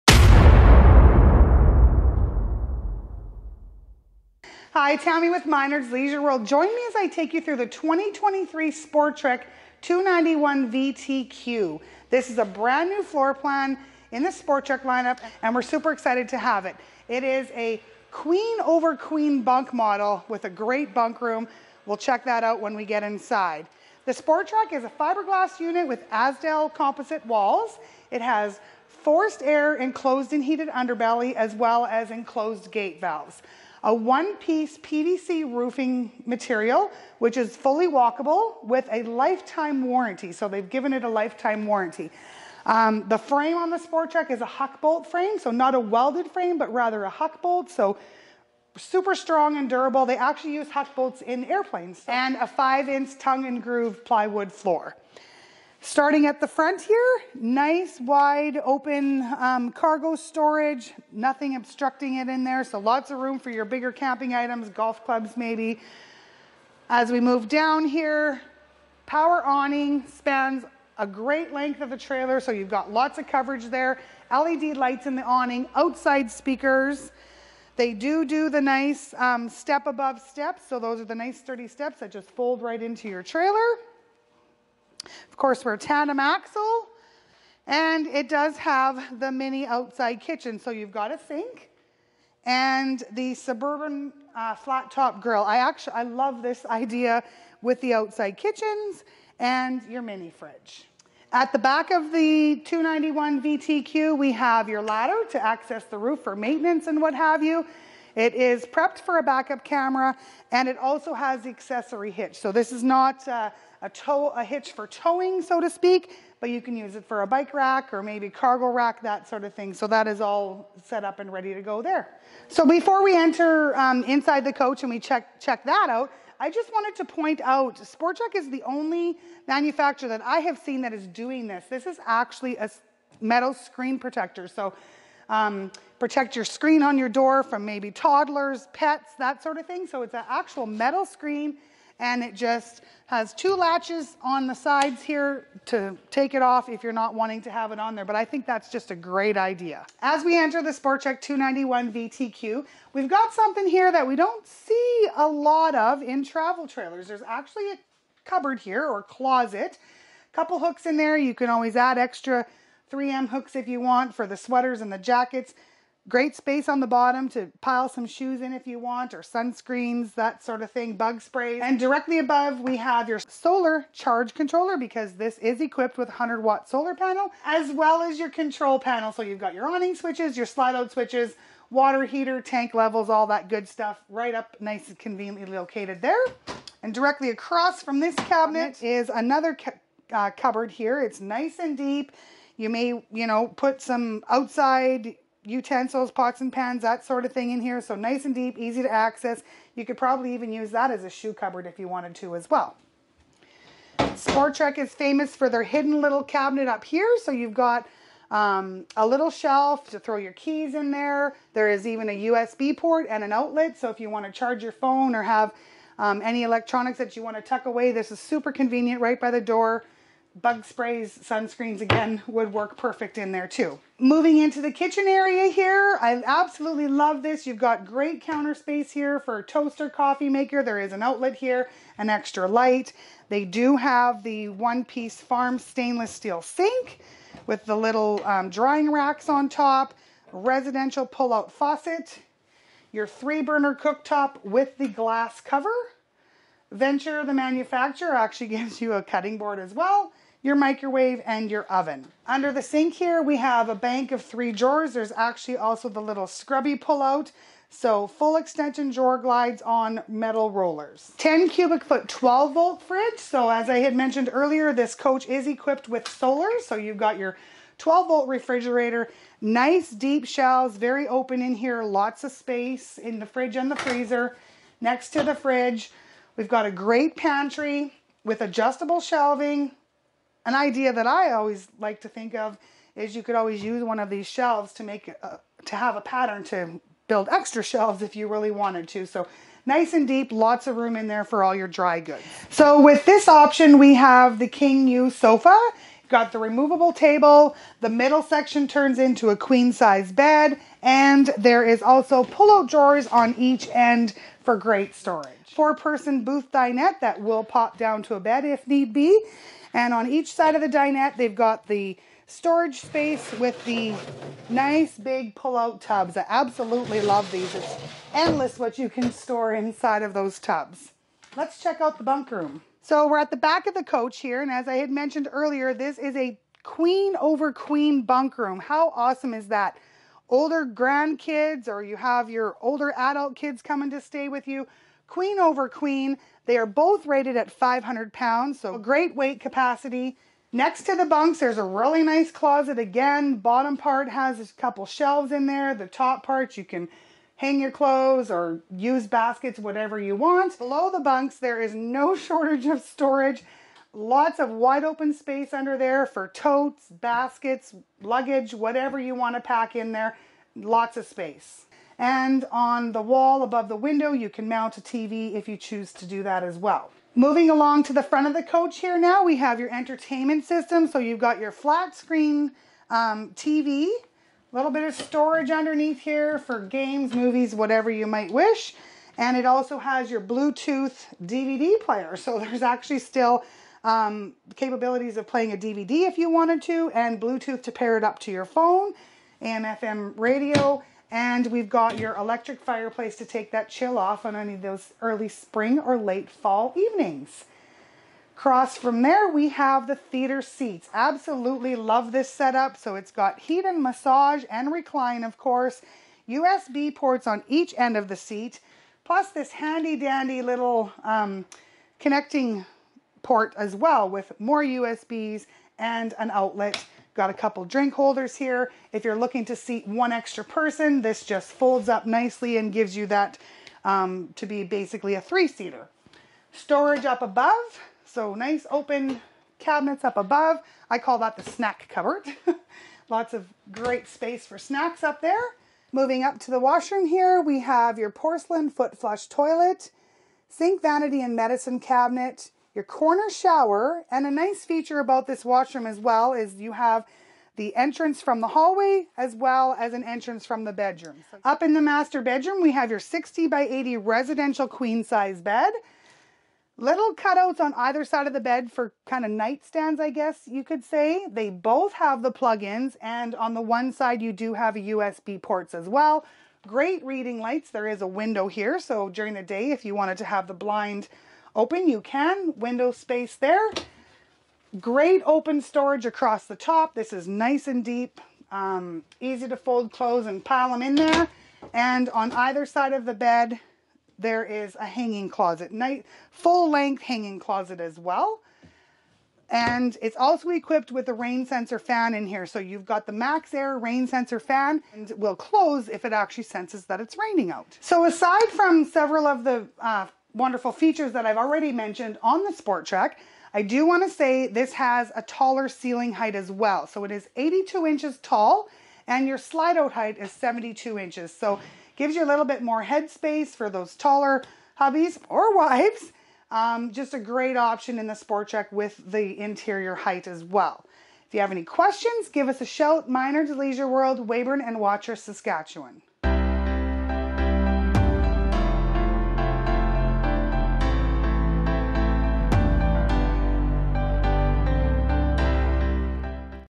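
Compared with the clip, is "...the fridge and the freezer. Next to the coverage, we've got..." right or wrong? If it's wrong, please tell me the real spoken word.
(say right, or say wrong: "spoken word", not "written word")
wrong: "fridge", not "coverage".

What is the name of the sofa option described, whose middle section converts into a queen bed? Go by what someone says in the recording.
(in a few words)
King U sofa.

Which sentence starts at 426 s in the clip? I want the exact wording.
Storage up above, so nice open cabinets up above.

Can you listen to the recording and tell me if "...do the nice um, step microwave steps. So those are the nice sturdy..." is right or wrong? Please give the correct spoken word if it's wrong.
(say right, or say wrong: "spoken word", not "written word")
wrong: "above", not "microwave".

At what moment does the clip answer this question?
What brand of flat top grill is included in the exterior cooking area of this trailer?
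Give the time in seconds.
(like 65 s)
93 s.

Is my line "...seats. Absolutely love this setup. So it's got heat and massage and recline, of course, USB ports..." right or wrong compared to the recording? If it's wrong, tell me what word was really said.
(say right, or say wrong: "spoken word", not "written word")
right.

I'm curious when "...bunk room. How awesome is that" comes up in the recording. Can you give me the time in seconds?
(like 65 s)
328 s.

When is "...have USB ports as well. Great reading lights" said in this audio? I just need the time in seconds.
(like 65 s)
464 s.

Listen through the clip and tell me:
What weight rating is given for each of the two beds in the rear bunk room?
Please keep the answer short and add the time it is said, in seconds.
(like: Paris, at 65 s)
500 pounds, at 337 s.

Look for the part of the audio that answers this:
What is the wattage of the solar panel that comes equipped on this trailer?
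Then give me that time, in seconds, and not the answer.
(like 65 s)
176 s.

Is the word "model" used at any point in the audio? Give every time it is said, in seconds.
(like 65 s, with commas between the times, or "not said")
19 s.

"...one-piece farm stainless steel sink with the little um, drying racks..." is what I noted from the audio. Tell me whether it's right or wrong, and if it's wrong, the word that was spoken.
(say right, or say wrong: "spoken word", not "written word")
right.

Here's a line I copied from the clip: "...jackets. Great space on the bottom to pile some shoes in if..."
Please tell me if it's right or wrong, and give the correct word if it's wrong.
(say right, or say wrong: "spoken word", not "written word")
right.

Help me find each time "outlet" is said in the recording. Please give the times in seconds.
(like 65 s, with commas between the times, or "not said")
213 s, 231 s, 416 s.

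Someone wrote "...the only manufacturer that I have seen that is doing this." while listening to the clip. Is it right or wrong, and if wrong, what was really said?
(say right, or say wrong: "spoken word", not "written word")
right.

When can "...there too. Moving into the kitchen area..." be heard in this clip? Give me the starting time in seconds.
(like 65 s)
223 s.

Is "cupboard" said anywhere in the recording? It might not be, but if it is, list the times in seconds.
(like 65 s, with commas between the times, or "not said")
158 s, 190 s, 201 s, 431 s.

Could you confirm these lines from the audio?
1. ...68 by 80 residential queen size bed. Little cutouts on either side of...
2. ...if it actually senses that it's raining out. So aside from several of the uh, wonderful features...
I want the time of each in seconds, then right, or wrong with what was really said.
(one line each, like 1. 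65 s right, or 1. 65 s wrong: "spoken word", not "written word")
1. 452 s wrong: "60", not "68"
2. 495 s right.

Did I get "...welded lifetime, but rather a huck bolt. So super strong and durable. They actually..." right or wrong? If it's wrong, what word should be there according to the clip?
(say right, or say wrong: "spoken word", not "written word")
wrong: "frame", not "lifetime".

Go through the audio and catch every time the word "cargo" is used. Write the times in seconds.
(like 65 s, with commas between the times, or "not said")
59 s, 118 s.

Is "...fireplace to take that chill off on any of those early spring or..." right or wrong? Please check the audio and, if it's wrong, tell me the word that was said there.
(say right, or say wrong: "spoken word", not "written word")
right.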